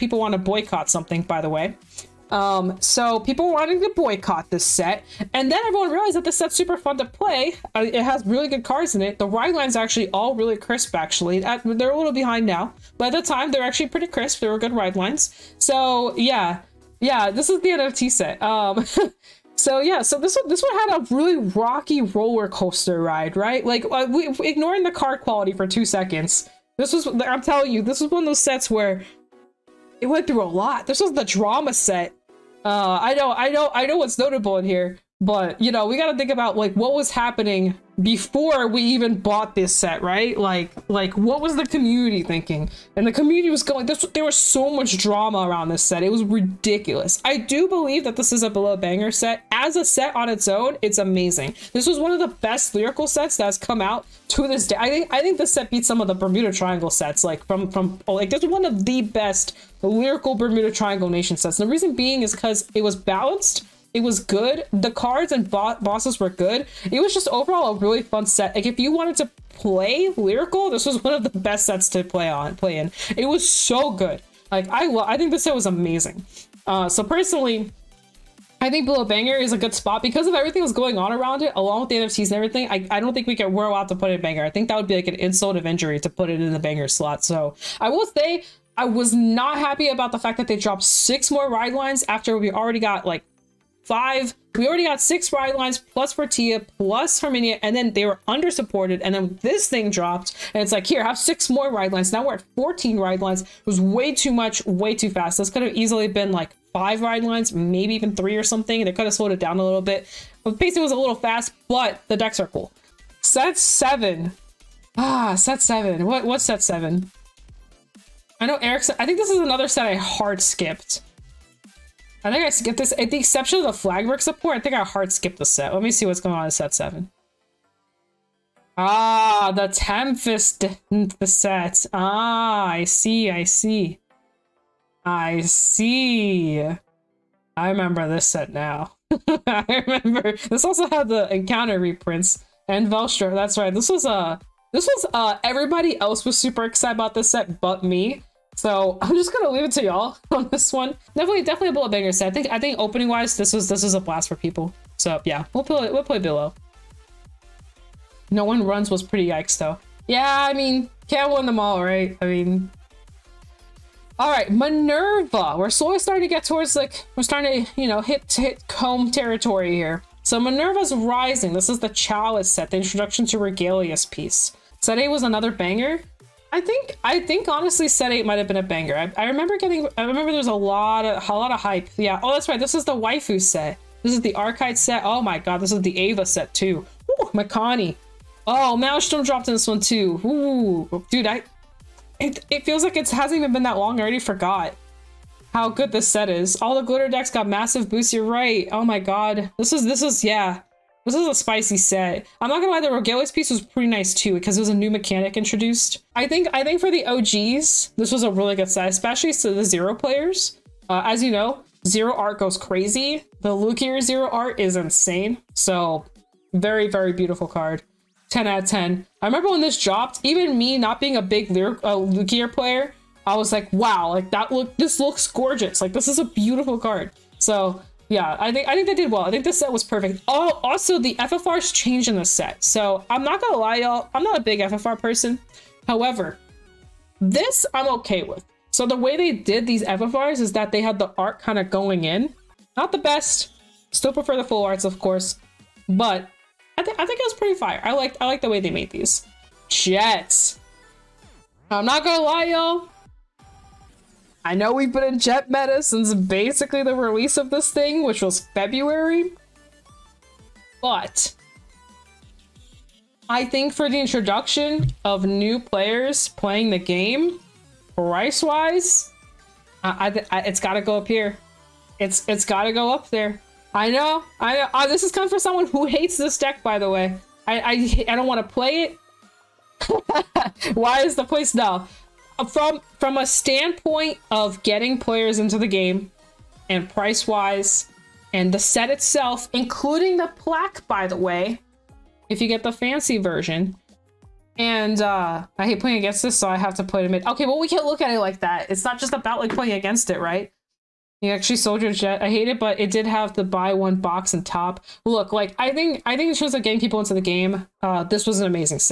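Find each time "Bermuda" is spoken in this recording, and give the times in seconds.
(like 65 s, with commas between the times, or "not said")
56 s, 60 s.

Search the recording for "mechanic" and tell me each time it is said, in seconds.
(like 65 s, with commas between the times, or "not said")
204 s.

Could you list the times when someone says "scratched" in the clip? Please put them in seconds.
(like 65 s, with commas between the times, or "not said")
not said.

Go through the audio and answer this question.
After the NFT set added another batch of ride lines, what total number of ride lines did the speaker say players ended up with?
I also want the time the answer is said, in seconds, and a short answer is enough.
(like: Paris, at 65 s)
14, at 102 s.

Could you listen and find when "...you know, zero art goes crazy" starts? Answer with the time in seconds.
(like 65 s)
211 s.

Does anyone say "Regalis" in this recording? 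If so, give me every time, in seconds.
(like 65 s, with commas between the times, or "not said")
173 s, 202 s.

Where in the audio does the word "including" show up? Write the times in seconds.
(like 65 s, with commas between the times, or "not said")
289 s.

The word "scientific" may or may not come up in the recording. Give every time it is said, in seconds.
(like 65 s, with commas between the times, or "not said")
not said.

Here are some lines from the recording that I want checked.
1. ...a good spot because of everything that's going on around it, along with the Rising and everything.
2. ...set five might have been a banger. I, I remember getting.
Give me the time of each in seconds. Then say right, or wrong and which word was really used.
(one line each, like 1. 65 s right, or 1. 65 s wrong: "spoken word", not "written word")
1. 79 s wrong: "NFTs", not "Rising"
2. 177 s wrong: "eight", not "five".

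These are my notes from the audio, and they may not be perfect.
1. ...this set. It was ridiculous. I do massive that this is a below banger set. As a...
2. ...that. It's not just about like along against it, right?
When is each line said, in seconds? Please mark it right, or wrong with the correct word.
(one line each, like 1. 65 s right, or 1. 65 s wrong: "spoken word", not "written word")
1. 45 s wrong: "believe", not "massive"
2. 298 s wrong: "playing", not "along".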